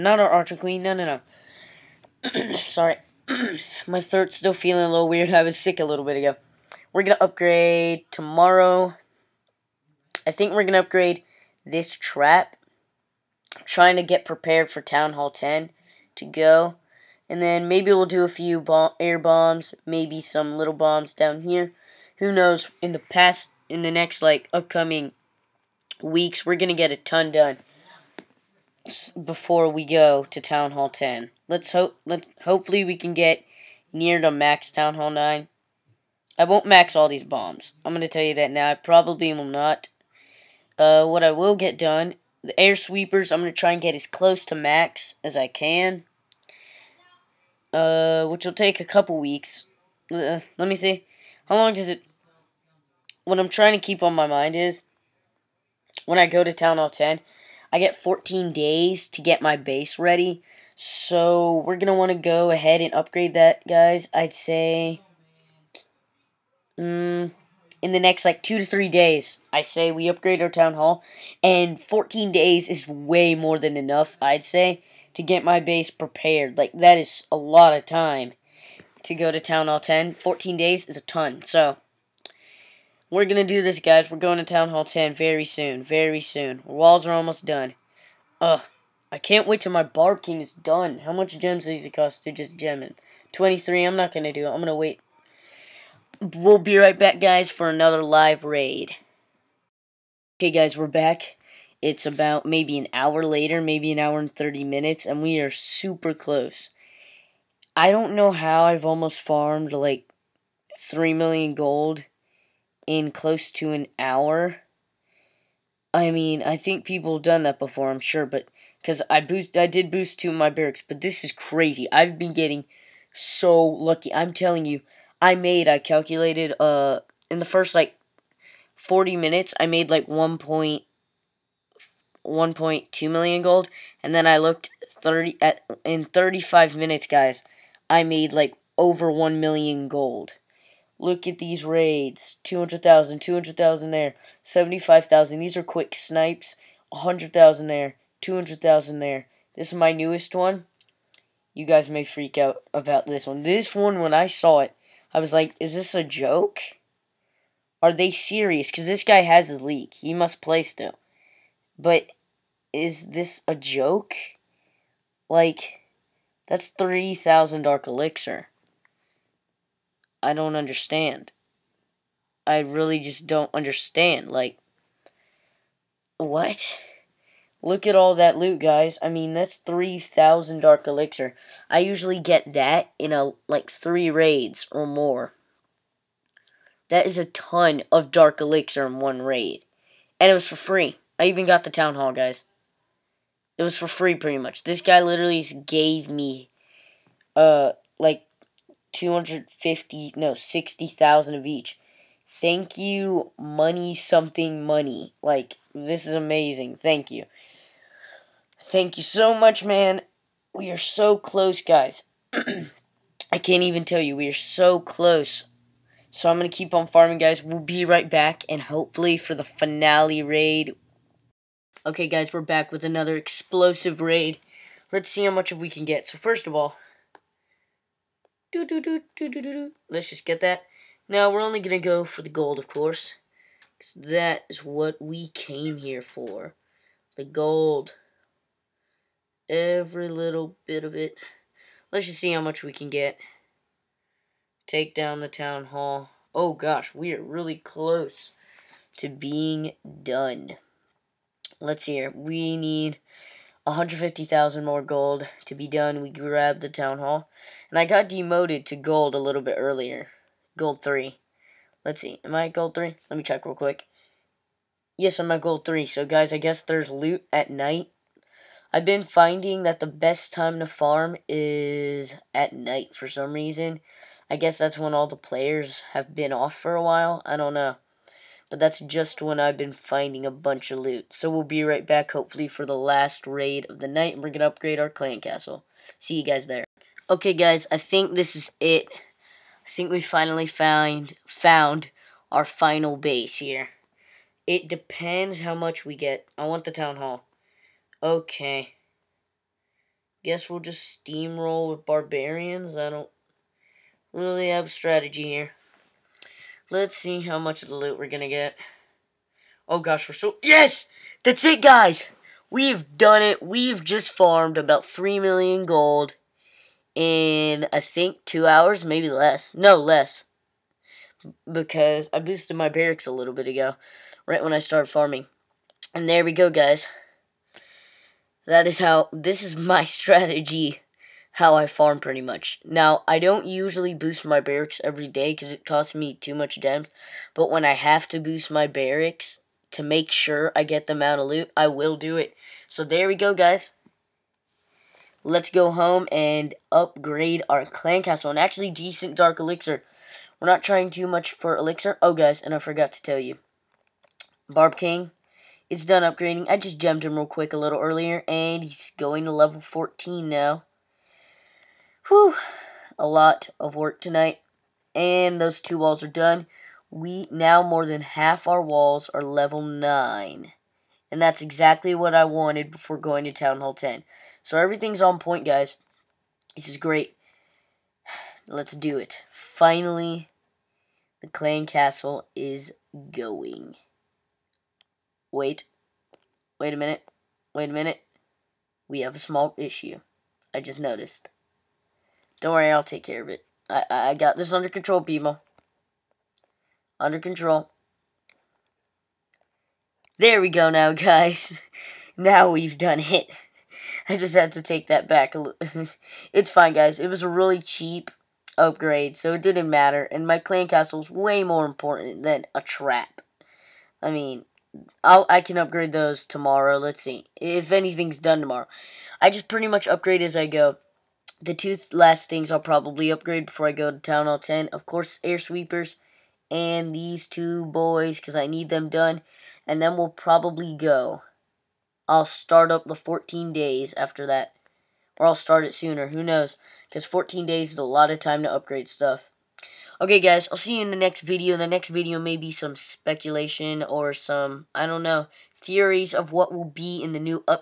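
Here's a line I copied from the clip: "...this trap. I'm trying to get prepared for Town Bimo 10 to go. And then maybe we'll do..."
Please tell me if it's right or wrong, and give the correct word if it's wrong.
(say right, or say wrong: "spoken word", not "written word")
wrong: "Hall", not "Bimo".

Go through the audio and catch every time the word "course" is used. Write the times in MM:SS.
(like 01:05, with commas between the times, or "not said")
03:52, 07:04.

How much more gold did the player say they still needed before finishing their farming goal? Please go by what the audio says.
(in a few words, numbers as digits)
150,000.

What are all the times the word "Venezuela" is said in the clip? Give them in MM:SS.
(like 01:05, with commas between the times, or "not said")
not said.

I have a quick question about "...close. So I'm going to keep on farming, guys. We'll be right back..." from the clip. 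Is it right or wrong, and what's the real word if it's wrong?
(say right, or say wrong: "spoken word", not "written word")
right.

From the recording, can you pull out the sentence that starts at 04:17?
And I got demoted to gold a little bit earlier.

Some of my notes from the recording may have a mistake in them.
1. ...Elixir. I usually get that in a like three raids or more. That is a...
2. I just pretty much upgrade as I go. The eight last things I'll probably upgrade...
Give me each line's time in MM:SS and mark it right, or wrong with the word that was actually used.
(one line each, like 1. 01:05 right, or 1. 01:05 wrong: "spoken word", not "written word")
1. 03:00 right
2. 06:59 wrong: "two", not "eight".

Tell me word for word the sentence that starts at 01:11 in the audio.
And 14 days is way more than enough, I'd say, to get my base prepared.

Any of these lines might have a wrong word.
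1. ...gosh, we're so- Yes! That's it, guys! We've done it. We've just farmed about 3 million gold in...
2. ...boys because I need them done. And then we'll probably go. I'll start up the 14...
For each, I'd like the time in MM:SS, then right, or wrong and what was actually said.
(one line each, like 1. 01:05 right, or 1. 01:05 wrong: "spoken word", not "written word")
1. 05:09 right
2. 07:07 right.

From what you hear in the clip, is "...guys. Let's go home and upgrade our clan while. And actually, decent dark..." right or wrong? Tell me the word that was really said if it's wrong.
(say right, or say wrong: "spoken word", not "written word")
wrong: "castle", not "while".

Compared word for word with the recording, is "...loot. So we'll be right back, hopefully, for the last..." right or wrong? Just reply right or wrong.
right.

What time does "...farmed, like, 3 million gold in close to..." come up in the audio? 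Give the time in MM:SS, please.
01:49.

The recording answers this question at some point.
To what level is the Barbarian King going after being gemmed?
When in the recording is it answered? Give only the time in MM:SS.
05:59.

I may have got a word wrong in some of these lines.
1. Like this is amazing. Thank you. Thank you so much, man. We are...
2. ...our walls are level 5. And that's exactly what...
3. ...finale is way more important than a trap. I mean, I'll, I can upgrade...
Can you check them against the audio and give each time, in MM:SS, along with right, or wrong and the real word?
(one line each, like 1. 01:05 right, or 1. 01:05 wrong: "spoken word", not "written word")
1. 03:25 right
2. 06:08 wrong: "9", not "5"
3. 06:50 wrong: "castle", not "finale".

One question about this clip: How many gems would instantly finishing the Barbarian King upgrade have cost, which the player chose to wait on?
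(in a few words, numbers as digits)
23.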